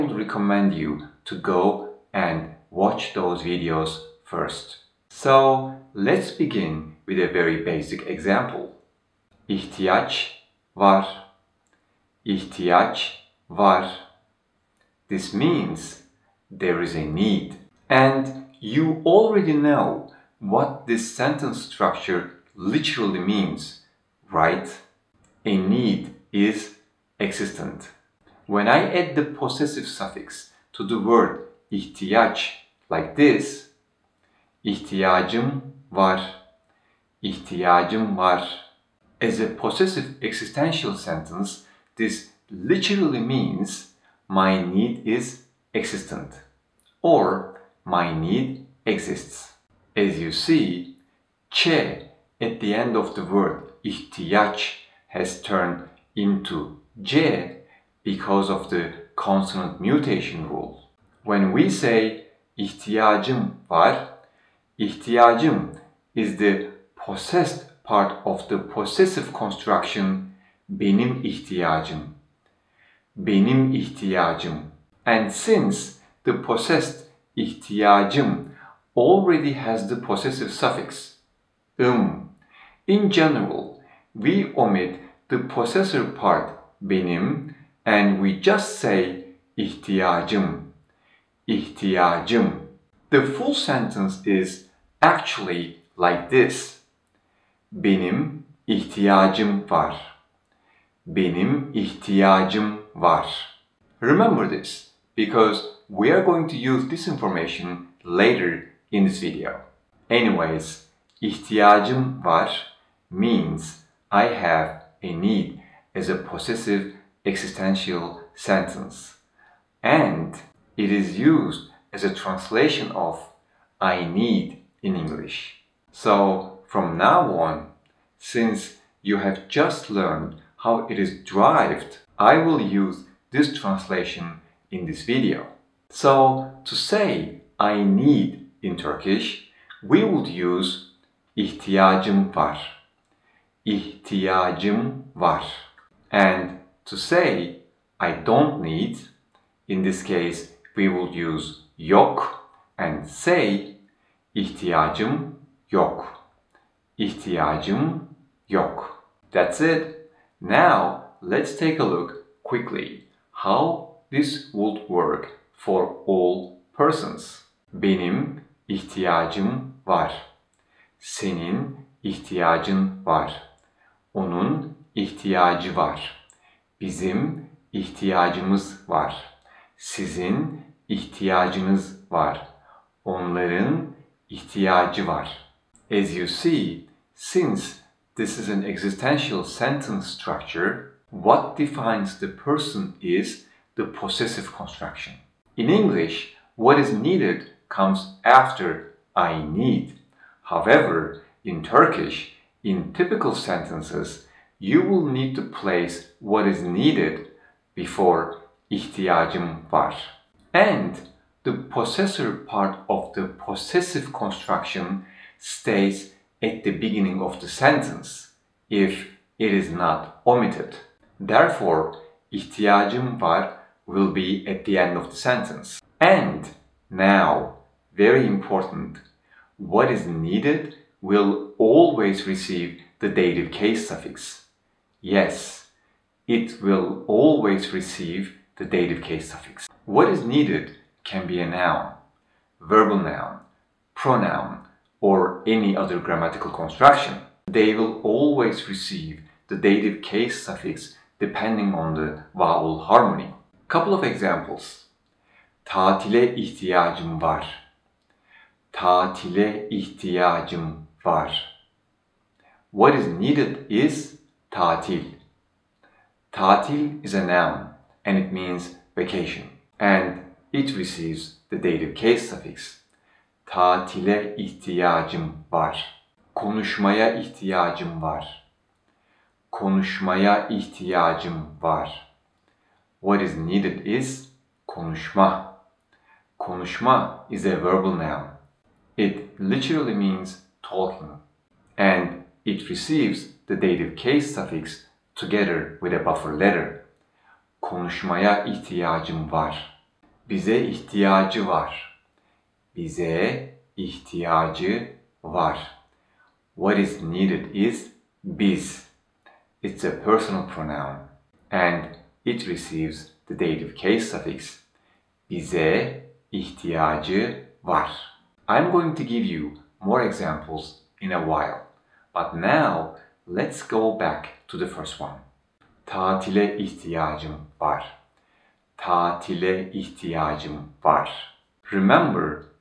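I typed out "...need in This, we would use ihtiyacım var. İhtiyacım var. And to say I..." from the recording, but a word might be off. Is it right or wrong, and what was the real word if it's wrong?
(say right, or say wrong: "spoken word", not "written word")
wrong: "Turkish", not "This".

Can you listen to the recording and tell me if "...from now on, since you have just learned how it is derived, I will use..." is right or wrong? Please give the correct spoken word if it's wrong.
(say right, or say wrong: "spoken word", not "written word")
right.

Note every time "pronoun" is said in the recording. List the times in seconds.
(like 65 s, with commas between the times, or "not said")
243 s, 310 s.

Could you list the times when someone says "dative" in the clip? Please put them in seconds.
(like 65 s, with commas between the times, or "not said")
233 s, 238 s, 249 s, 271 s, 293 s, 313 s.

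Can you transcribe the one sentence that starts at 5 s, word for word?
So let's begin with a very basic example.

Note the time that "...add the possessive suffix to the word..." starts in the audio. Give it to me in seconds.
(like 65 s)
28 s.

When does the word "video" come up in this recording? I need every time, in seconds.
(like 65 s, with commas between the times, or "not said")
3 s, 109 s, 135 s.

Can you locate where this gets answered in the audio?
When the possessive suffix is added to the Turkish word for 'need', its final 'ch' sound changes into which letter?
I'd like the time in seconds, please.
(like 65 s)
55 s.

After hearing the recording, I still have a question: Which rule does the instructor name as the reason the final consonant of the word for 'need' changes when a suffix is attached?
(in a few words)
consonant mutation rule.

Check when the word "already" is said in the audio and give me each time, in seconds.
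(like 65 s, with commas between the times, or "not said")
19 s, 78 s.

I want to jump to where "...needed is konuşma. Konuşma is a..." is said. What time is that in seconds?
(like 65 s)
283 s.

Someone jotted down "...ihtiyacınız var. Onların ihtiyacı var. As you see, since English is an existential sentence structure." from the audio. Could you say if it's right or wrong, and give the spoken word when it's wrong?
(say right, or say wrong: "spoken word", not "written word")
wrong: "This", not "English".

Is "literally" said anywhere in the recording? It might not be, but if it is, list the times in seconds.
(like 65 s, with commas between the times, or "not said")
22 s, 42 s, 289 s.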